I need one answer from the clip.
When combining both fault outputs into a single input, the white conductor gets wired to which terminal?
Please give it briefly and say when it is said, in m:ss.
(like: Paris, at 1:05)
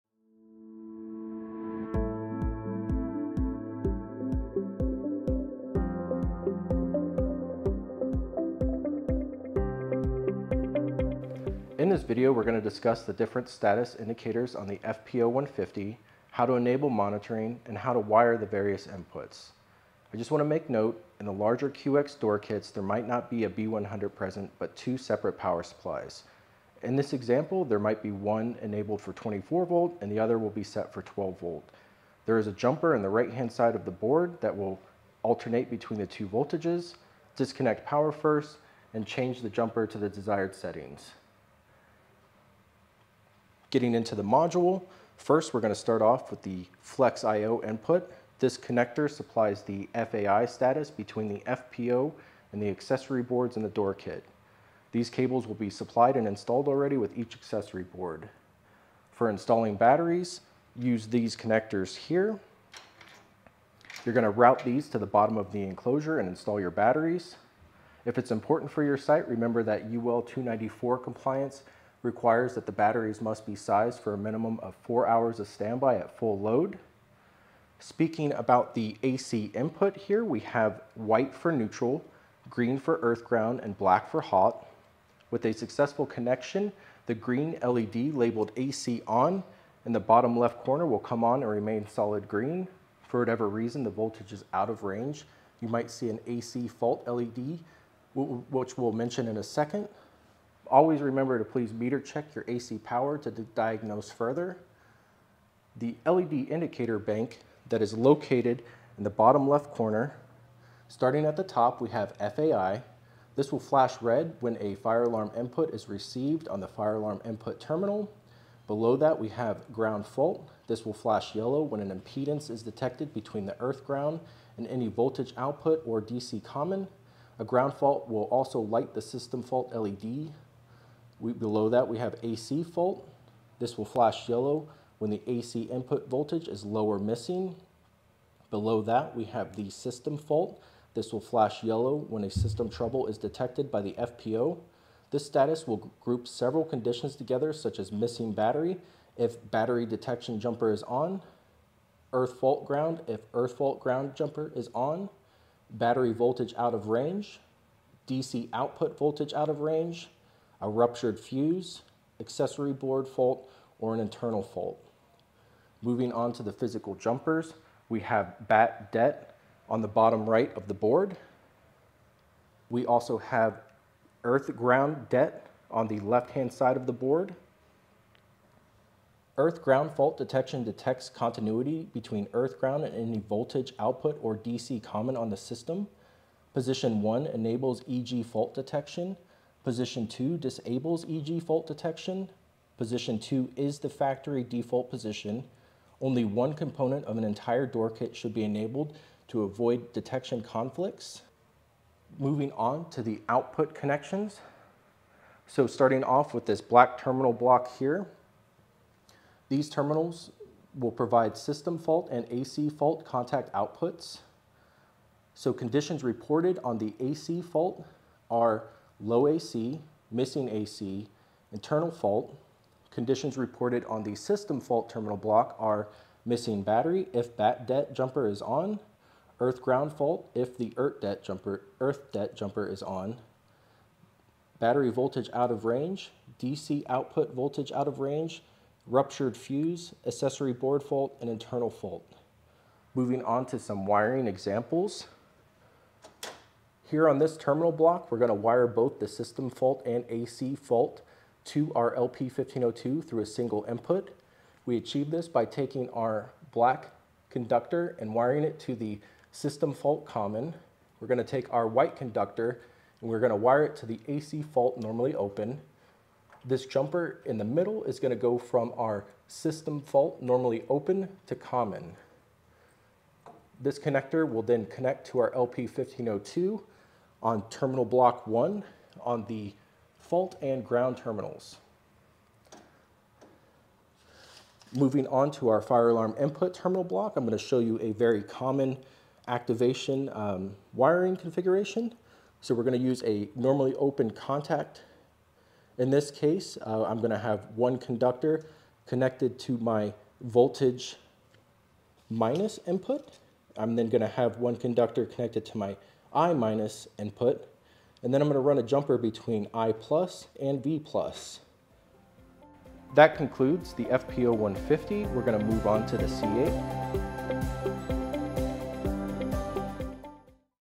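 AC fault normally open, at 4:24.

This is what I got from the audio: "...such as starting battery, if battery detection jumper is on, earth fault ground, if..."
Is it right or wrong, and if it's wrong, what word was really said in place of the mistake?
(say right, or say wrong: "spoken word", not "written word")
wrong: "missing", not "starting".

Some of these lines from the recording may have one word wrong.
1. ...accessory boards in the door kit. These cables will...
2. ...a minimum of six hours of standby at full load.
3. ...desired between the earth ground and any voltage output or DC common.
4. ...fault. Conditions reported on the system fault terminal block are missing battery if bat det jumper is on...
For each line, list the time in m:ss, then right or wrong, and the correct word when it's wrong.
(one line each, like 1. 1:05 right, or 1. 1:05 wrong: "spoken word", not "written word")
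1. 0:52 right
2. 1:14 wrong: "four", not "six"
3. 2:02 wrong: "detected", not "desired"
4. 3:41 right.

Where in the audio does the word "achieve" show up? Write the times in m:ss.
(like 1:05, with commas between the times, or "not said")
4:14.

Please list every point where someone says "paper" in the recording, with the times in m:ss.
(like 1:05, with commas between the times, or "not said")
not said.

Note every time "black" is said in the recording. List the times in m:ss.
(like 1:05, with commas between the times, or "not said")
1:23, 3:26, 4:16.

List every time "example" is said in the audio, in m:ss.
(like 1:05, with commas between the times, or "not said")
0:27, 4:04.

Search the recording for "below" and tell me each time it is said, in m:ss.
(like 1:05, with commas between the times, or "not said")
1:58, 2:11, 2:18.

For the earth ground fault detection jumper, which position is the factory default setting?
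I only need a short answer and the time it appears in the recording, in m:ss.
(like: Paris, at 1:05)
Position 2, at 3:12.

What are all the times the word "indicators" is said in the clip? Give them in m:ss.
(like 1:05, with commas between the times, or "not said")
0:13, 1:46.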